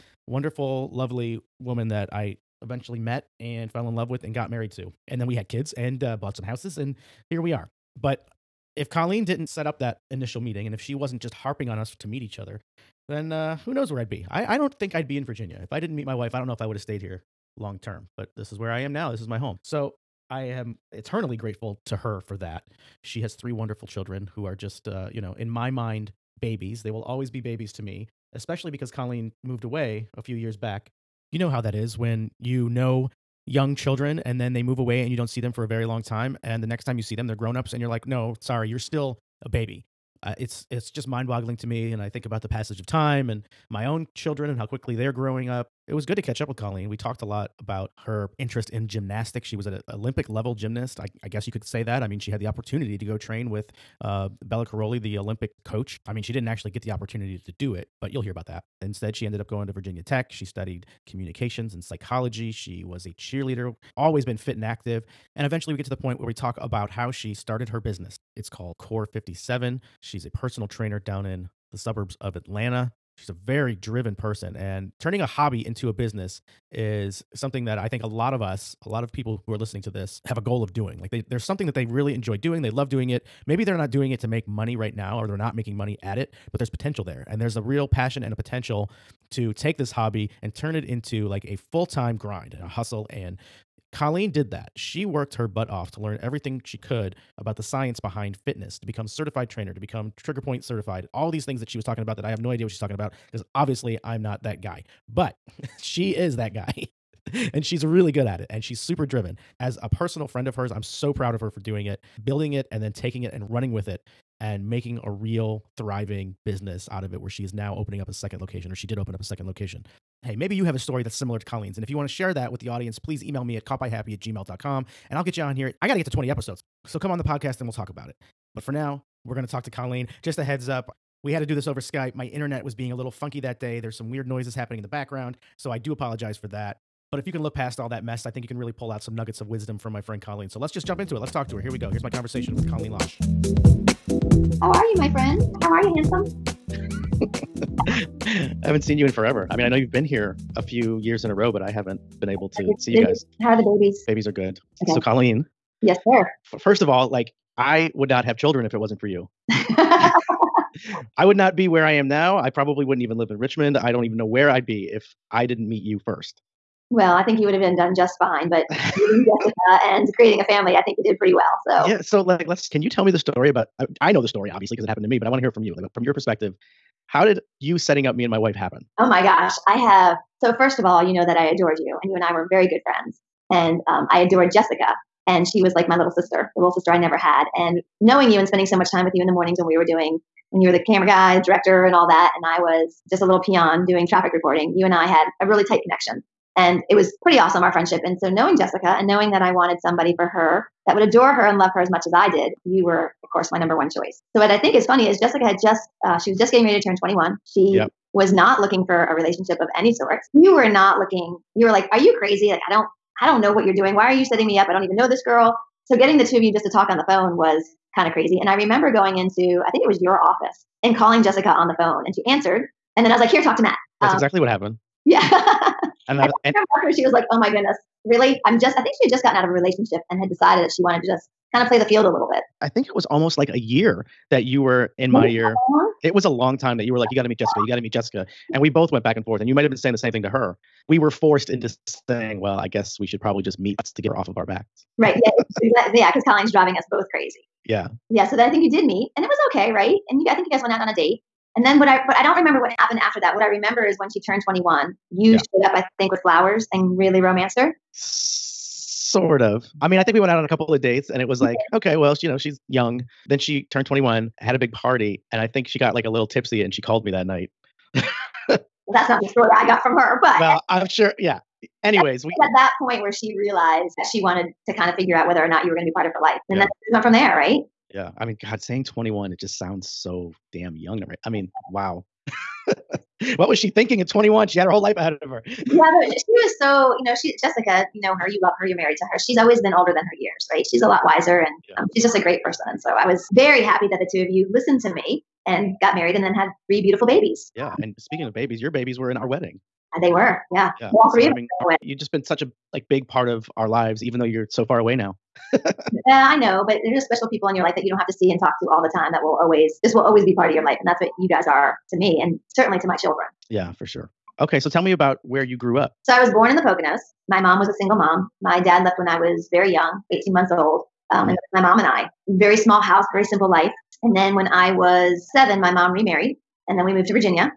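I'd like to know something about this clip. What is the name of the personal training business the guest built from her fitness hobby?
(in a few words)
Core 57.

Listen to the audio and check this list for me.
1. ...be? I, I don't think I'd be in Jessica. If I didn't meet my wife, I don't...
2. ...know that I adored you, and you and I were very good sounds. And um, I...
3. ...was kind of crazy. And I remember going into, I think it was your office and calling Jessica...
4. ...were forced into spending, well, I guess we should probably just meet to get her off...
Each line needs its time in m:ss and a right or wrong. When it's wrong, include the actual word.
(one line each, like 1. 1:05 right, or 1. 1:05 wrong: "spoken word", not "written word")
1. 0:14 wrong: "Virginia", not "Jessica"
2. 3:01 wrong: "friends", not "sounds"
3. 3:37 right
4. 4:00 wrong: "saying", not "spending".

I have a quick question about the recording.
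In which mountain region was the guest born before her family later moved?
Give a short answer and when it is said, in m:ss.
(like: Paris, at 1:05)
The Poconos, at 5:16.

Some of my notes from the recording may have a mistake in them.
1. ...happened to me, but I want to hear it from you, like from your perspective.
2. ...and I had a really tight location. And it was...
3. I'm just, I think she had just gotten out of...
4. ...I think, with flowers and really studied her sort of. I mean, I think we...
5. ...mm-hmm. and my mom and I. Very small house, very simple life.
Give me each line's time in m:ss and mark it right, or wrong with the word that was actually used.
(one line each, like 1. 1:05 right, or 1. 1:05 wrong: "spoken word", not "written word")
1. 2:54 right
2. 3:14 wrong: "connection", not "location"
3. 3:48 right
4. 4:15 wrong: "romanced", not "studied"
5. 5:21 right.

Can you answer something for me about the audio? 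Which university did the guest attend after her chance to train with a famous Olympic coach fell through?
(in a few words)
Virginia Tech.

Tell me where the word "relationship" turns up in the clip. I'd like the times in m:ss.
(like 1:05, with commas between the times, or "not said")
3:29, 3:49.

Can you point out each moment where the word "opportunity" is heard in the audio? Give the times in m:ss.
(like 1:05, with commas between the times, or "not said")
0:52, 0:56.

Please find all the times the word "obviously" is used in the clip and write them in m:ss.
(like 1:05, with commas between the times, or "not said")
1:43, 2:54.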